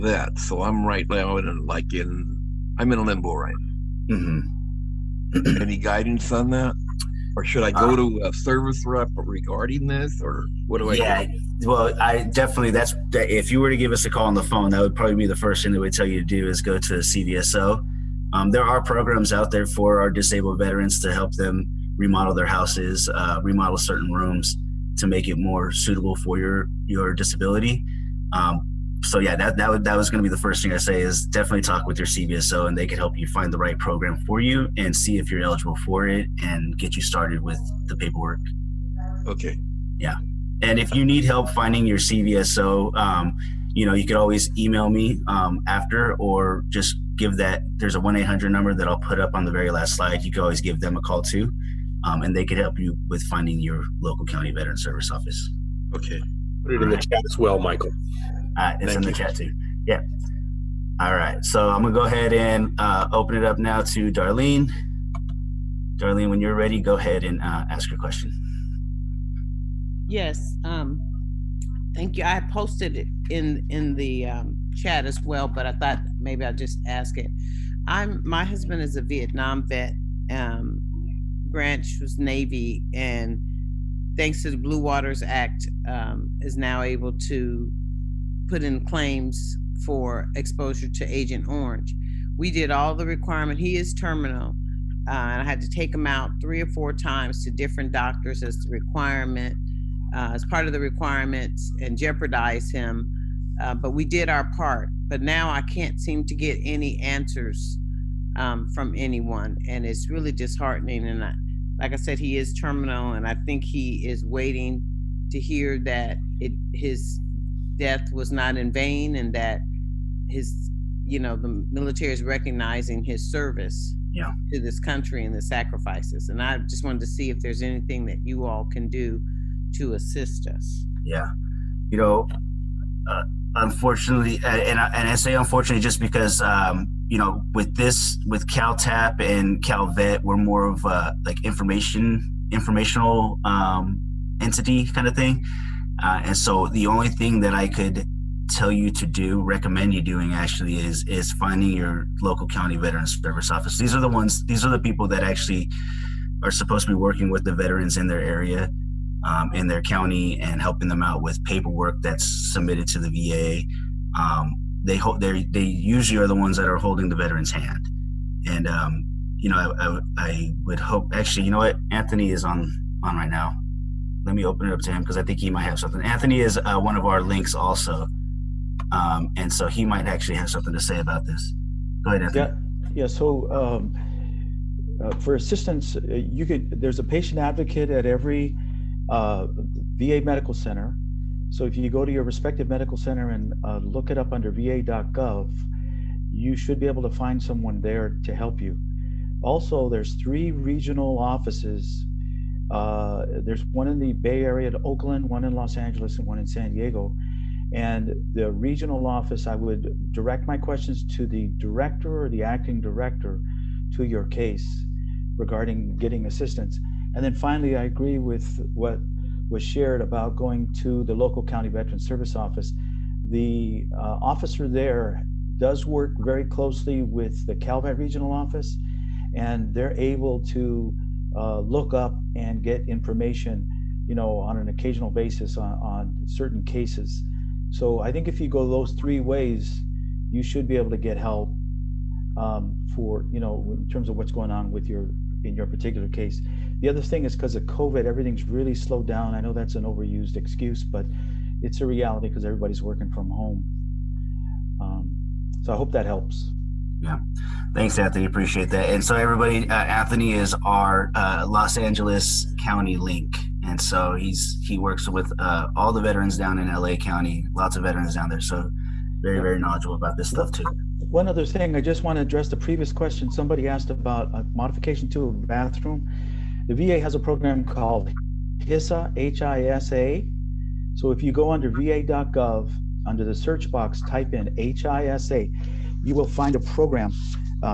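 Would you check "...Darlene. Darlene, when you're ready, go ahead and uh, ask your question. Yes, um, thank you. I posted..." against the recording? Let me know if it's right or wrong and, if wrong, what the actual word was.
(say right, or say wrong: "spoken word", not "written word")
right.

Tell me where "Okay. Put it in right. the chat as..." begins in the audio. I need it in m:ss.
0:55.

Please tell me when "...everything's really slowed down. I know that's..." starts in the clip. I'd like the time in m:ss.
4:08.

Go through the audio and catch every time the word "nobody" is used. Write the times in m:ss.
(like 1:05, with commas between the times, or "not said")
not said.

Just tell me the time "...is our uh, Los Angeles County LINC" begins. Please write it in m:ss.
4:20.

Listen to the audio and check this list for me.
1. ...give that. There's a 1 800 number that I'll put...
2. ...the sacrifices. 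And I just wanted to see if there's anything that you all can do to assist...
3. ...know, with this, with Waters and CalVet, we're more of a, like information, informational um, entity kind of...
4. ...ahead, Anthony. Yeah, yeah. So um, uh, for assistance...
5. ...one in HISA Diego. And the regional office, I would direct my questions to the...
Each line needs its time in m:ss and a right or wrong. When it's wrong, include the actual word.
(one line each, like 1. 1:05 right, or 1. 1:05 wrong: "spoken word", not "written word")
1. 0:47 right
2. 2:05 right
3. 2:17 wrong: "CalTap", not "Waters"
4. 3:02 right
5. 3:26 wrong: "San", not "HISA".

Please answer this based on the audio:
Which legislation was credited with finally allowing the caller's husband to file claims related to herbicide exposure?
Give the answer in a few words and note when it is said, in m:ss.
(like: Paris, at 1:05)
Blue Waters Act, at 1:24.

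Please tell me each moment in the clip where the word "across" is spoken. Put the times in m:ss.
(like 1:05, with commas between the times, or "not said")
not said.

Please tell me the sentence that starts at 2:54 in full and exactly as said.
Let me open it up to him because I think he might have something.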